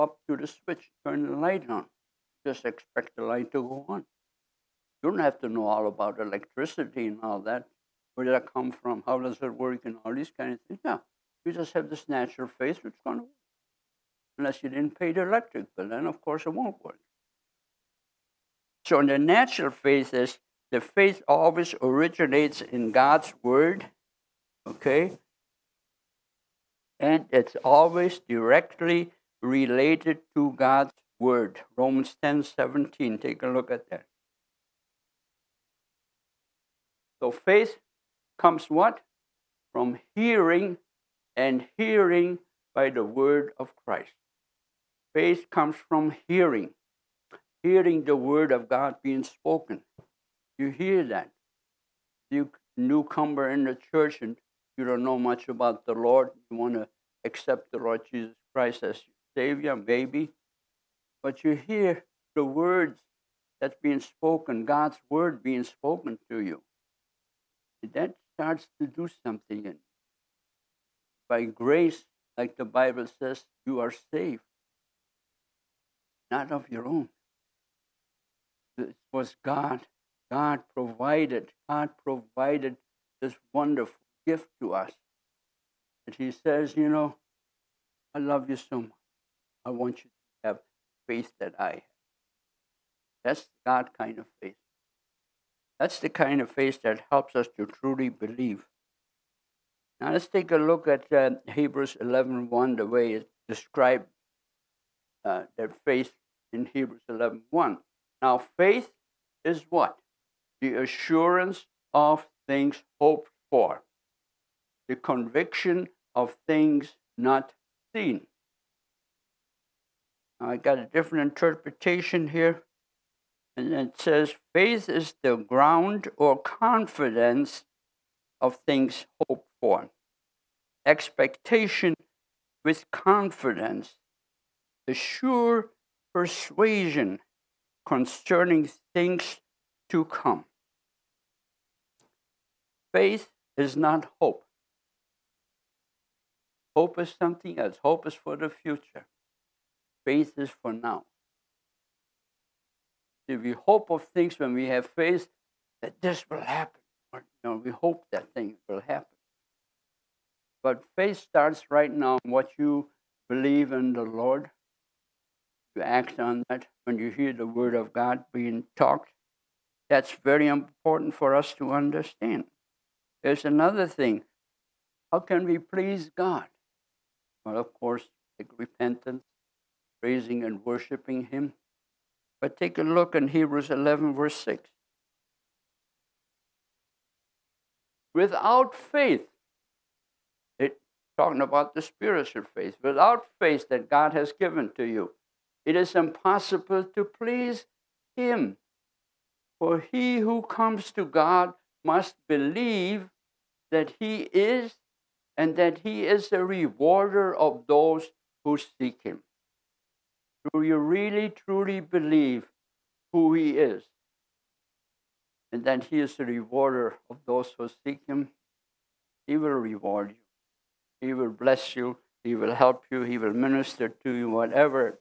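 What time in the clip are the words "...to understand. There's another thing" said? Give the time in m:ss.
2:51.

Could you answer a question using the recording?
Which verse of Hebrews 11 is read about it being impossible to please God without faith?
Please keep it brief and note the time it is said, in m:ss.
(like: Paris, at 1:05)
Verse 6, at 3:04.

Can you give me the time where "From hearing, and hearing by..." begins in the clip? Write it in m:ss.
0:39.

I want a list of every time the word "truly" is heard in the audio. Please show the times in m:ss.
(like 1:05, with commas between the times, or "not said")
1:37, 3:31.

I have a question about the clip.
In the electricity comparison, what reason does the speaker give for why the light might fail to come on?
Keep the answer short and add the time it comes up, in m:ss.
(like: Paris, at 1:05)
Didn't pay the electric bill, at 0:14.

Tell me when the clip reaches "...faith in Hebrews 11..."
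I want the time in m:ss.
1:45.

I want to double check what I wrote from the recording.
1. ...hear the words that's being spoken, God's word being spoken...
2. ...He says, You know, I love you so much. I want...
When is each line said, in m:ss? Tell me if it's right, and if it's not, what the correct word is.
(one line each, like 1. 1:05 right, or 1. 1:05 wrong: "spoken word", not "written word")
1. 1:01 right
2. 1:26 right.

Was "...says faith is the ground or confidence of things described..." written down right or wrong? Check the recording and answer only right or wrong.
wrong.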